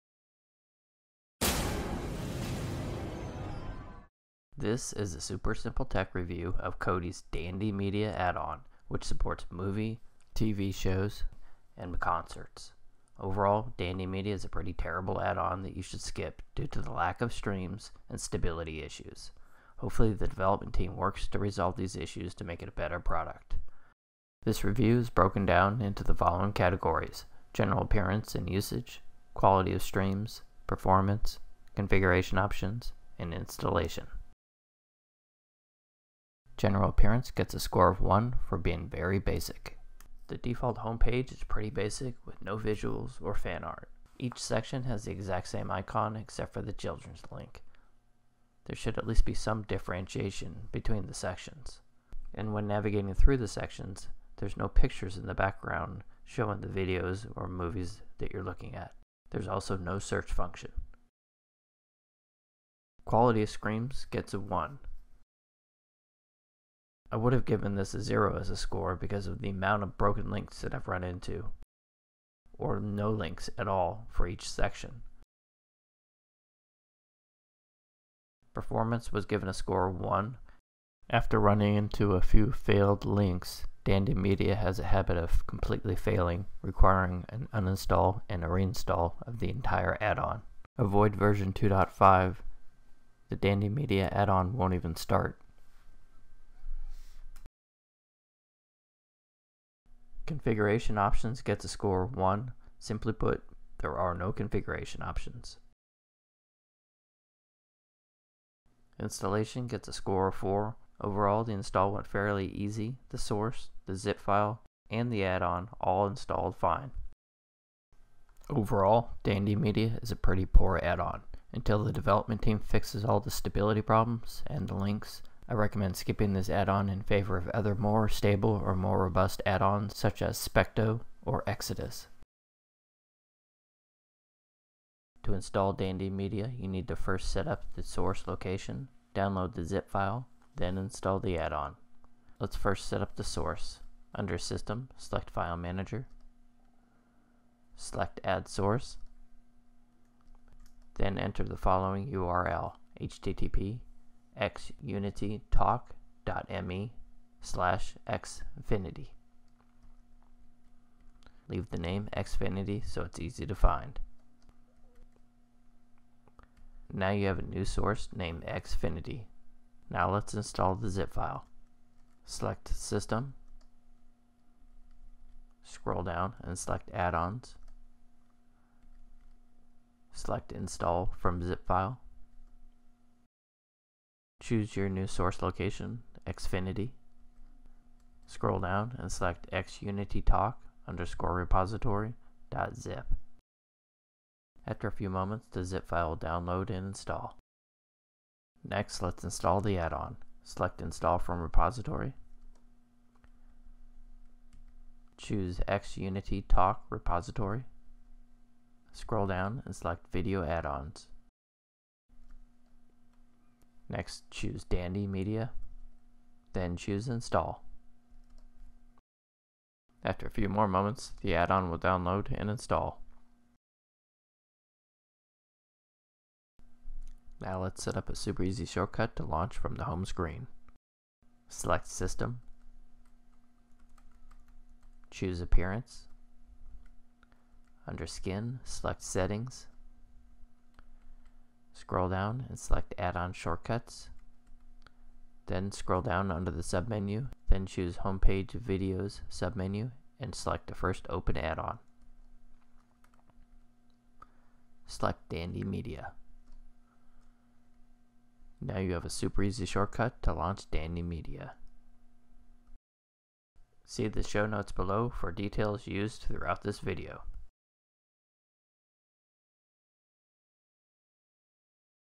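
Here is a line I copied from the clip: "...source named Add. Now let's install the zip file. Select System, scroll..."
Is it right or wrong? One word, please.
wrong.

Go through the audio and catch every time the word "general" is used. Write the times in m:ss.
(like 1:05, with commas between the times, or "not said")
0:27, 0:36.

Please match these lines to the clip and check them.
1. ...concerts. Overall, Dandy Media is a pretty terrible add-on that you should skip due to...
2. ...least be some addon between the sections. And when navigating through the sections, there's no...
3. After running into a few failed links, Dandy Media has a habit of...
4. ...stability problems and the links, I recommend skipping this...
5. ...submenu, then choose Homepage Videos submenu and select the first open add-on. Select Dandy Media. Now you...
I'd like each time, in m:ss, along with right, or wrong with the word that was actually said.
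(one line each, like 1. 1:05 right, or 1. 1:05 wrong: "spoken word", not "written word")
1. 0:11 right
2. 0:49 wrong: "differentiation", not "addon"
3. 1:21 right
4. 2:03 right
5. 4:06 right.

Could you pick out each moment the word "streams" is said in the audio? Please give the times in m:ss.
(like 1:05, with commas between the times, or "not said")
0:17, 0:29.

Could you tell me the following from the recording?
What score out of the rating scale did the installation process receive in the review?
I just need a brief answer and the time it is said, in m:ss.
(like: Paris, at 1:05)
4, at 1:48.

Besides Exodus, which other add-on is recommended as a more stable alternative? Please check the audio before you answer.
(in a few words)
Specto.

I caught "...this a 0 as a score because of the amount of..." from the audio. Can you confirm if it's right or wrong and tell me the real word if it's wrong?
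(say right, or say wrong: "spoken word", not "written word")
right.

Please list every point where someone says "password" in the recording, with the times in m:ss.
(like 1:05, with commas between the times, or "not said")
not said.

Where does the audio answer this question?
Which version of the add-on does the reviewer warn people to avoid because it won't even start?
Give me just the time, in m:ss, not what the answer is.
1:31.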